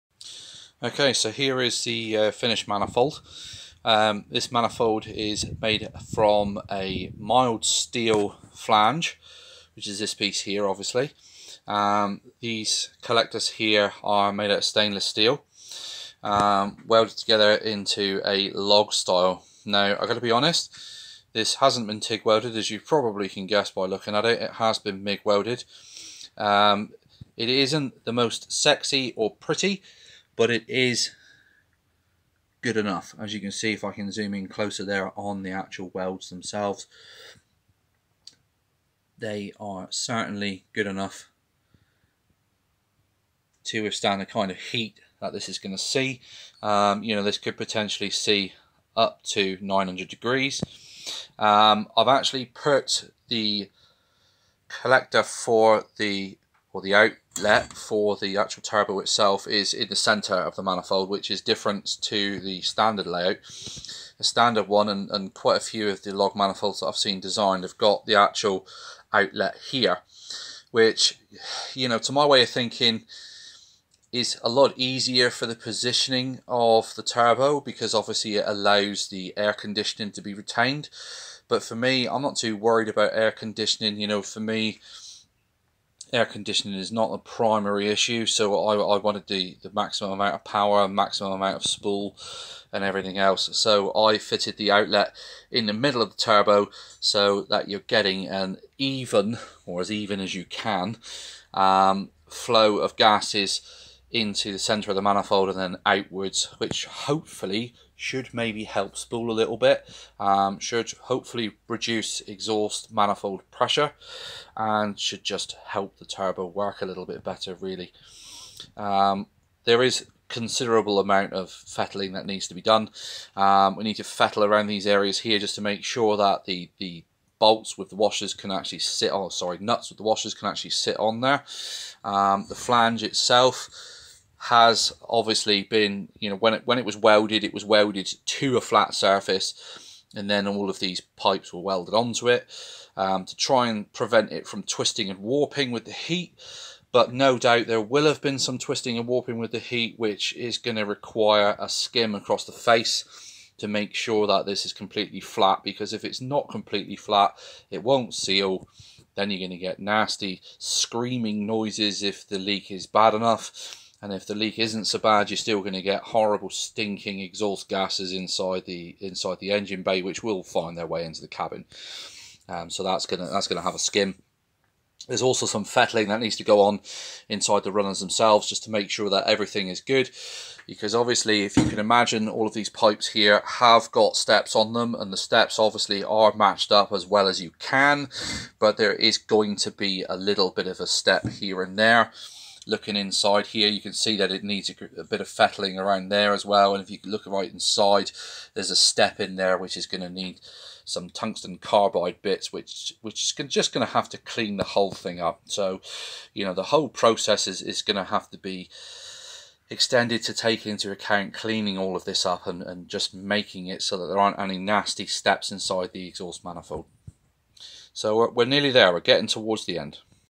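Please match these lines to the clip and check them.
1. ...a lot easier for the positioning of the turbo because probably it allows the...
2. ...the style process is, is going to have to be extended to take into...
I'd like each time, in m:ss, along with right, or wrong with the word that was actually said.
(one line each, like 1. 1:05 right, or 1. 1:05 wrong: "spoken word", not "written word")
1. 1:14 wrong: "obviously", not "probably"
2. 3:26 wrong: "whole", not "style".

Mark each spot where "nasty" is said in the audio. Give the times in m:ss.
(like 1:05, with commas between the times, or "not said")
2:39, 3:34.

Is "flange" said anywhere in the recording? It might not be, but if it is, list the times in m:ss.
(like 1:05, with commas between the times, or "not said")
0:08, 2:12.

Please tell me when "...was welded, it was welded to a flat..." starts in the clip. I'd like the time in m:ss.
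2:16.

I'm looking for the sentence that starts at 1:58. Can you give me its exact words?
Um, there is considerable amount of fettling that needs to be done.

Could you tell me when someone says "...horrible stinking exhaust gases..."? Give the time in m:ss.
2:46.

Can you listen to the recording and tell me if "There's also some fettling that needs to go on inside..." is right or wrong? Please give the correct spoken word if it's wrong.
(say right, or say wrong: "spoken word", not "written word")
right.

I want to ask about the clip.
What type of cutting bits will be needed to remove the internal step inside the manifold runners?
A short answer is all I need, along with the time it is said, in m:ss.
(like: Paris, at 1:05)
Tungsten carbide, at 3:21.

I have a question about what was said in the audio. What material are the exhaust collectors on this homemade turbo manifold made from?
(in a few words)
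Stainless steel.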